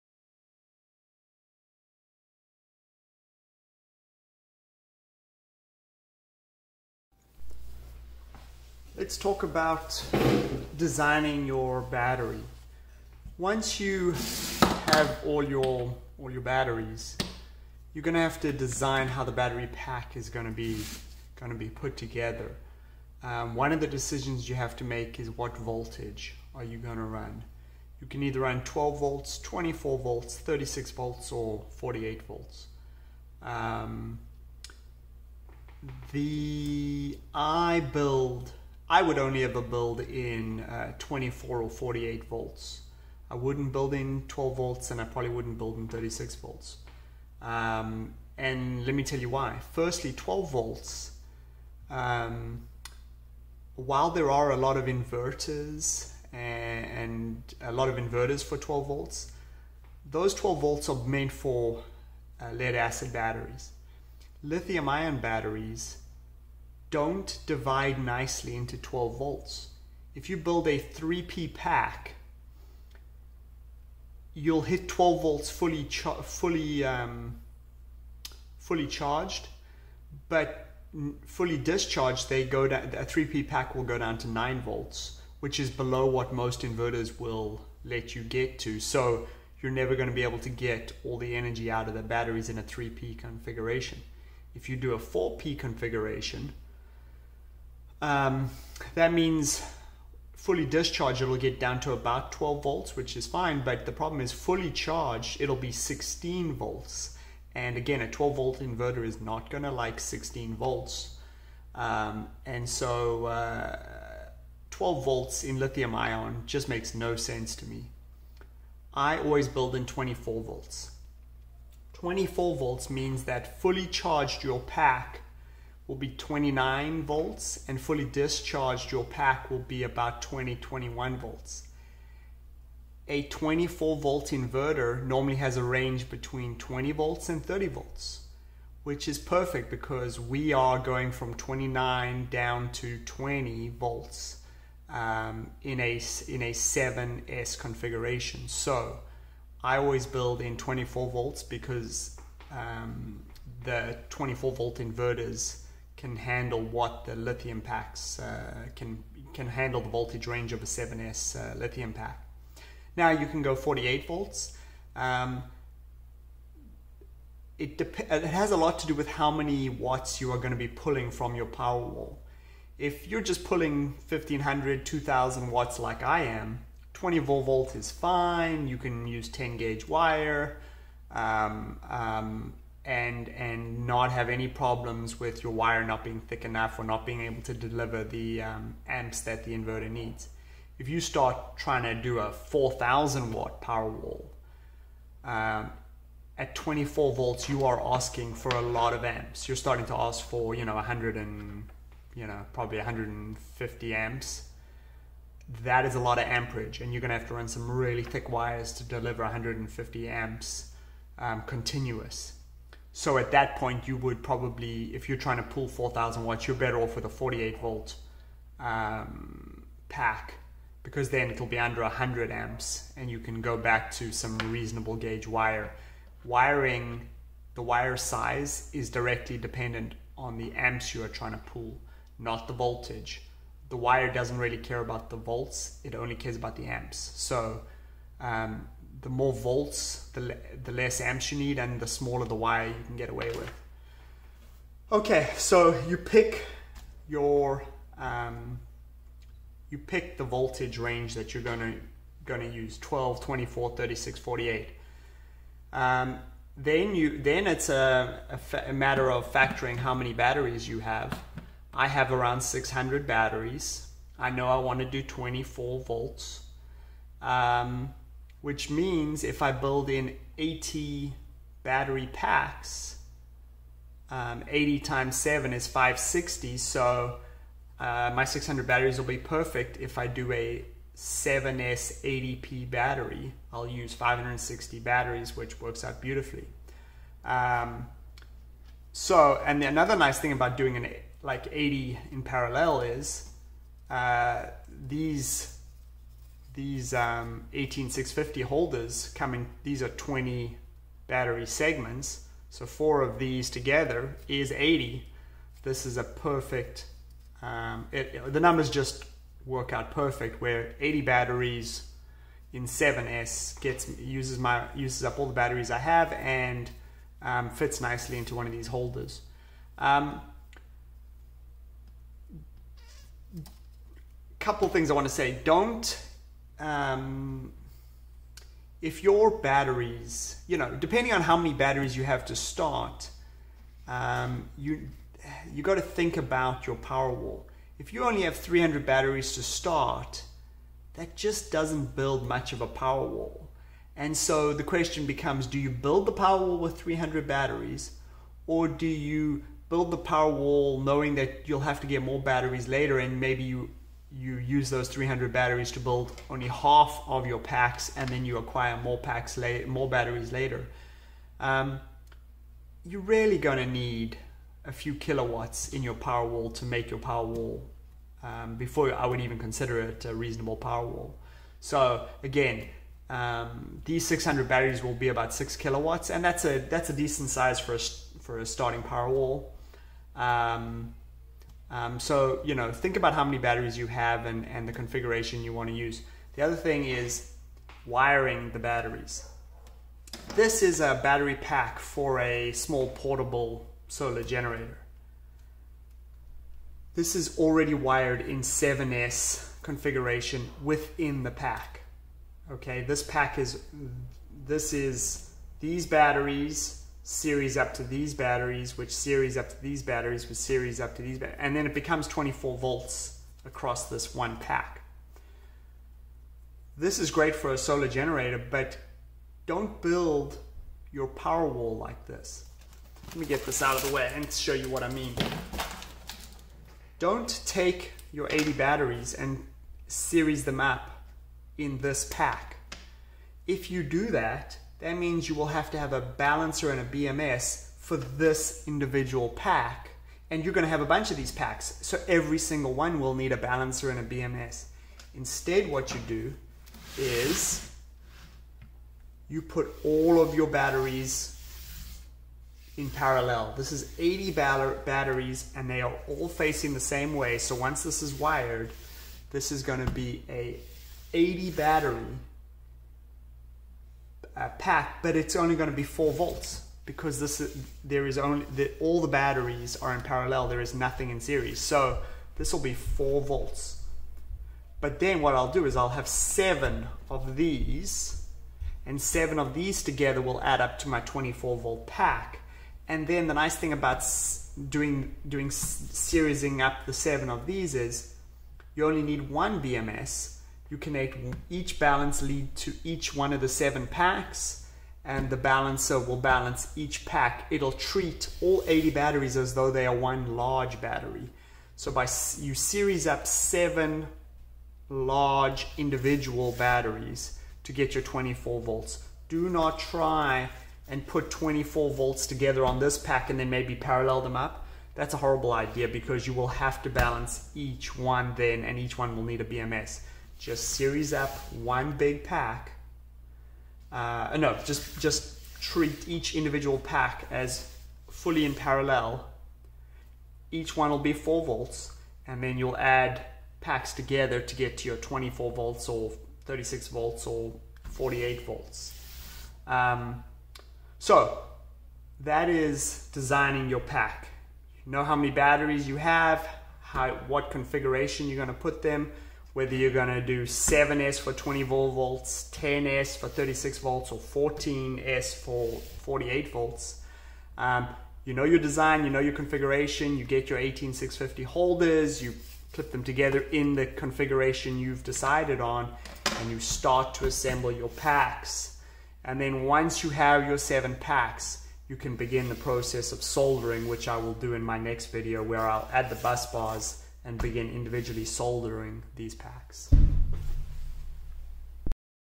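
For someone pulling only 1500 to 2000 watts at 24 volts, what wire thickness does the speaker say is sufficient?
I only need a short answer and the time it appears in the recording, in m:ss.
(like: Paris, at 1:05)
10 gauge, at 2:59.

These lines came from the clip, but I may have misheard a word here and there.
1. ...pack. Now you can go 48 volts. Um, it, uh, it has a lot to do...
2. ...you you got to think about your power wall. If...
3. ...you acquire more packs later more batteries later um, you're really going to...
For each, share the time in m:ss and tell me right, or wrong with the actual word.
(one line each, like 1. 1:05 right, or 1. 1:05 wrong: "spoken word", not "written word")
1. 2:41 right
2. 5:34 right
3. 5:58 right.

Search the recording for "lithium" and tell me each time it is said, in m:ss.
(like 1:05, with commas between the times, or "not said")
1:04, 1:55, 2:37, 2:41.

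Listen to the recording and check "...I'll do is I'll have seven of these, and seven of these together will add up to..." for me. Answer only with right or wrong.
right.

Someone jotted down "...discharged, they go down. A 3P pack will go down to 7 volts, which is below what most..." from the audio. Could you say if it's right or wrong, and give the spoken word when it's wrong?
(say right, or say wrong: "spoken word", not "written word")
wrong: "9", not "7".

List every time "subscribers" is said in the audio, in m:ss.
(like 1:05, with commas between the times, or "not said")
not said.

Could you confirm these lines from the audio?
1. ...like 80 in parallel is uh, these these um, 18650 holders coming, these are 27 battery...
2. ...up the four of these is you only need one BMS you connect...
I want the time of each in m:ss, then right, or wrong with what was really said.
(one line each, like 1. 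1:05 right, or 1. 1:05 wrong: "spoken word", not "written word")
1. 4:51 wrong: "20", not "27"
2. 8:06 wrong: "seven", not "four".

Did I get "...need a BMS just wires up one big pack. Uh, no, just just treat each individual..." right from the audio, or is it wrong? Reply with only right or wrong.
wrong.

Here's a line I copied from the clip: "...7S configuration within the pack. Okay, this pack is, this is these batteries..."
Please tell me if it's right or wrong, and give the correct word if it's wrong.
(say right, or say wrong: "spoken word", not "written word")
right.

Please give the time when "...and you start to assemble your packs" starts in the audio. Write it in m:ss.
9:26.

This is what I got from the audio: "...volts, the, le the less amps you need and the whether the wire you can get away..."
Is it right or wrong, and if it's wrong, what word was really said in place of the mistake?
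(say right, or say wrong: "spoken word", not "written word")
wrong: "smaller", not "whether".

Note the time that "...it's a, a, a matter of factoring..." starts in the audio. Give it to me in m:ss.
4:17.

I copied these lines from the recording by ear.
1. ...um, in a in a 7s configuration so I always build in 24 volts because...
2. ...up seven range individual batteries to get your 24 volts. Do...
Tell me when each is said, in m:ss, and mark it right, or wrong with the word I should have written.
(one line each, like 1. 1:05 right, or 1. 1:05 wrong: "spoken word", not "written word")
1. 2:24 right
2. 8:23 wrong: "large", not "range".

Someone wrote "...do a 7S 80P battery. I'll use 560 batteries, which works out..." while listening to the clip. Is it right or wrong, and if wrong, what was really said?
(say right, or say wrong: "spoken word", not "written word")
right.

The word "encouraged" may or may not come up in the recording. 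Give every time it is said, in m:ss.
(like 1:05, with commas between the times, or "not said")
not said.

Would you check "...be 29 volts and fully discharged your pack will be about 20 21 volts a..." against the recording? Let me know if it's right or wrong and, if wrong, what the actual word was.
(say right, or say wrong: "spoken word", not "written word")
right.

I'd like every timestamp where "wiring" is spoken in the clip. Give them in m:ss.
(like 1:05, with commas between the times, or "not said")
3:46, 6:27.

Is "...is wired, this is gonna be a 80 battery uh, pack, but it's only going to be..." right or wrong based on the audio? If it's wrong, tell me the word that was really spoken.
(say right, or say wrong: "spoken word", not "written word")
right.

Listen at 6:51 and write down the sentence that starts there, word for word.
And then it becomes 24 volts across this one pack.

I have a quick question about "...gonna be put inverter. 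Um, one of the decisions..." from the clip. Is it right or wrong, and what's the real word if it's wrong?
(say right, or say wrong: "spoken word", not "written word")
wrong: "together", not "inverter".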